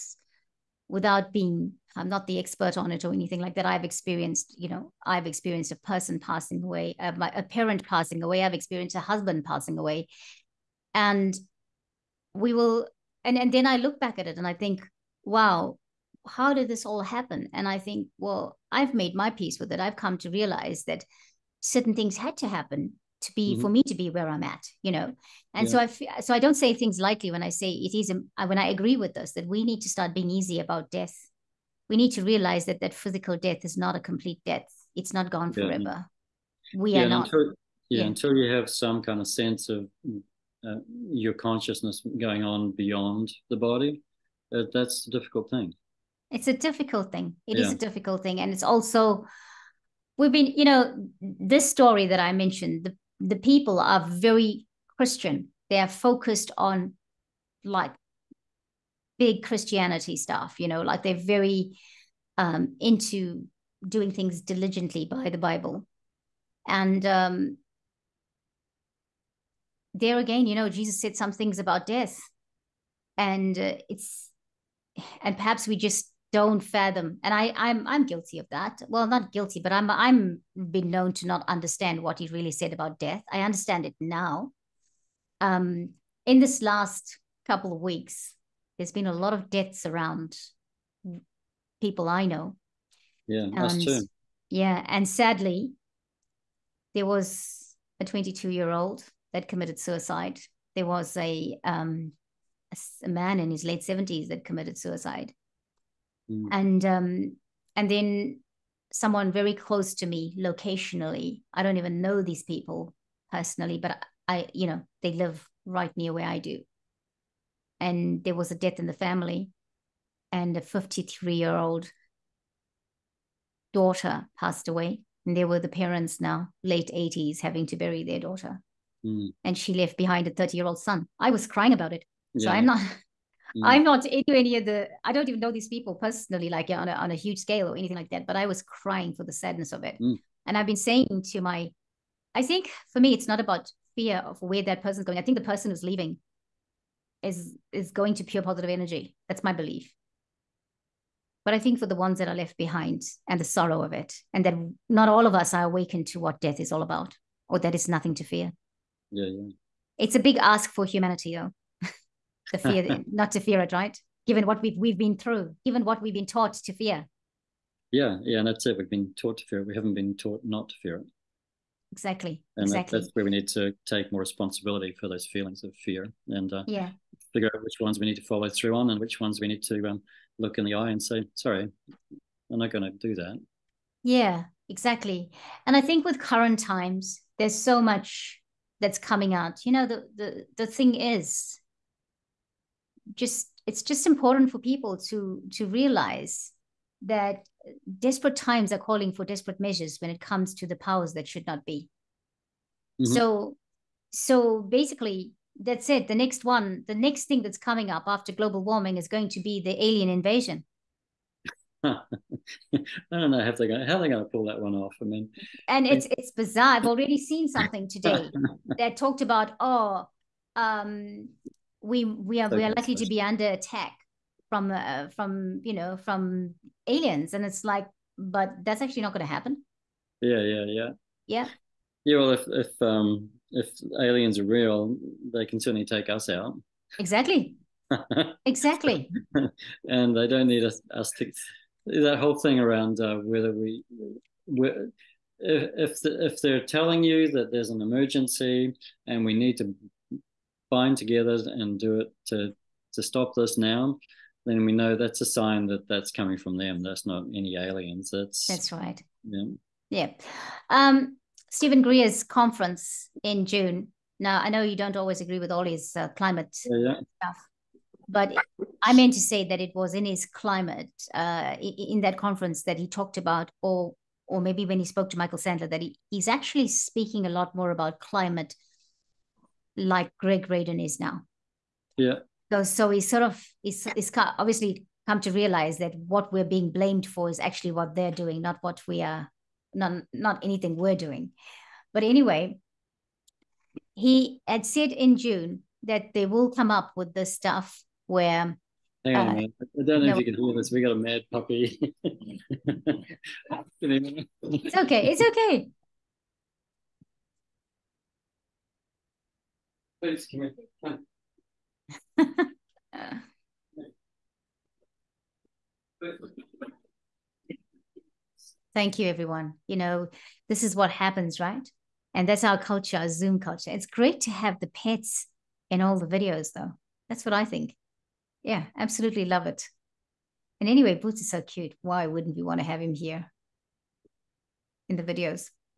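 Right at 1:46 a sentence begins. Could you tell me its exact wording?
and um, and then someone very close to me locationally.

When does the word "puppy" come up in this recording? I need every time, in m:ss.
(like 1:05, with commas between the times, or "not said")
5:01.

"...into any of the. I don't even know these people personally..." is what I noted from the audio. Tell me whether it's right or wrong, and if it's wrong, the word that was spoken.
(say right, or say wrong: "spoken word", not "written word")
right.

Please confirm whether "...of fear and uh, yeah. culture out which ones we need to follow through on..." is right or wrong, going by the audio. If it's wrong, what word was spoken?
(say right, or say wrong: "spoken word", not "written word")
wrong: "figure", not "culture".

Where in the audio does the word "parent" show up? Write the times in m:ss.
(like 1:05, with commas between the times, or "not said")
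0:07, 2:05.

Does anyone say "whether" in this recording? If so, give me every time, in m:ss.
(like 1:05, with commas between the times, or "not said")
4:03.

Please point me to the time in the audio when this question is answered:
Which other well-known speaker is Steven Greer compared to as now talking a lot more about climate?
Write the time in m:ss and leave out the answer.
4:40.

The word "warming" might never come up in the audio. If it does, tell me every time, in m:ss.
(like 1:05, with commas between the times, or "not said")
3:28.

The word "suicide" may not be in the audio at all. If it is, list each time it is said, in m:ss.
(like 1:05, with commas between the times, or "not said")
1:39, 1:44.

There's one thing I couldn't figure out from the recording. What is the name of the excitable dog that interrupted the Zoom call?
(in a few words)
Boots.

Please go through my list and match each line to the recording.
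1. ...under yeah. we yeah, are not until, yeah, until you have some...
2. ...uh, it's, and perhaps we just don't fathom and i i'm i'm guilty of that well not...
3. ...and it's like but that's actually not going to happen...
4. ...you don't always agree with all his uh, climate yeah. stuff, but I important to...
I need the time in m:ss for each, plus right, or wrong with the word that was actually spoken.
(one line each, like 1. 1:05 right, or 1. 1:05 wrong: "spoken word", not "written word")
1. 0:35 wrong: "forever", not "under"
2. 1:13 right
3. 3:47 right
4. 4:24 wrong: "meant", not "important".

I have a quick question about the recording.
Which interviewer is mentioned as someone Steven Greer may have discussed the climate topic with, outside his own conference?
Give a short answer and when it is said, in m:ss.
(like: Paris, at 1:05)
Michael Sandler, at 4:35.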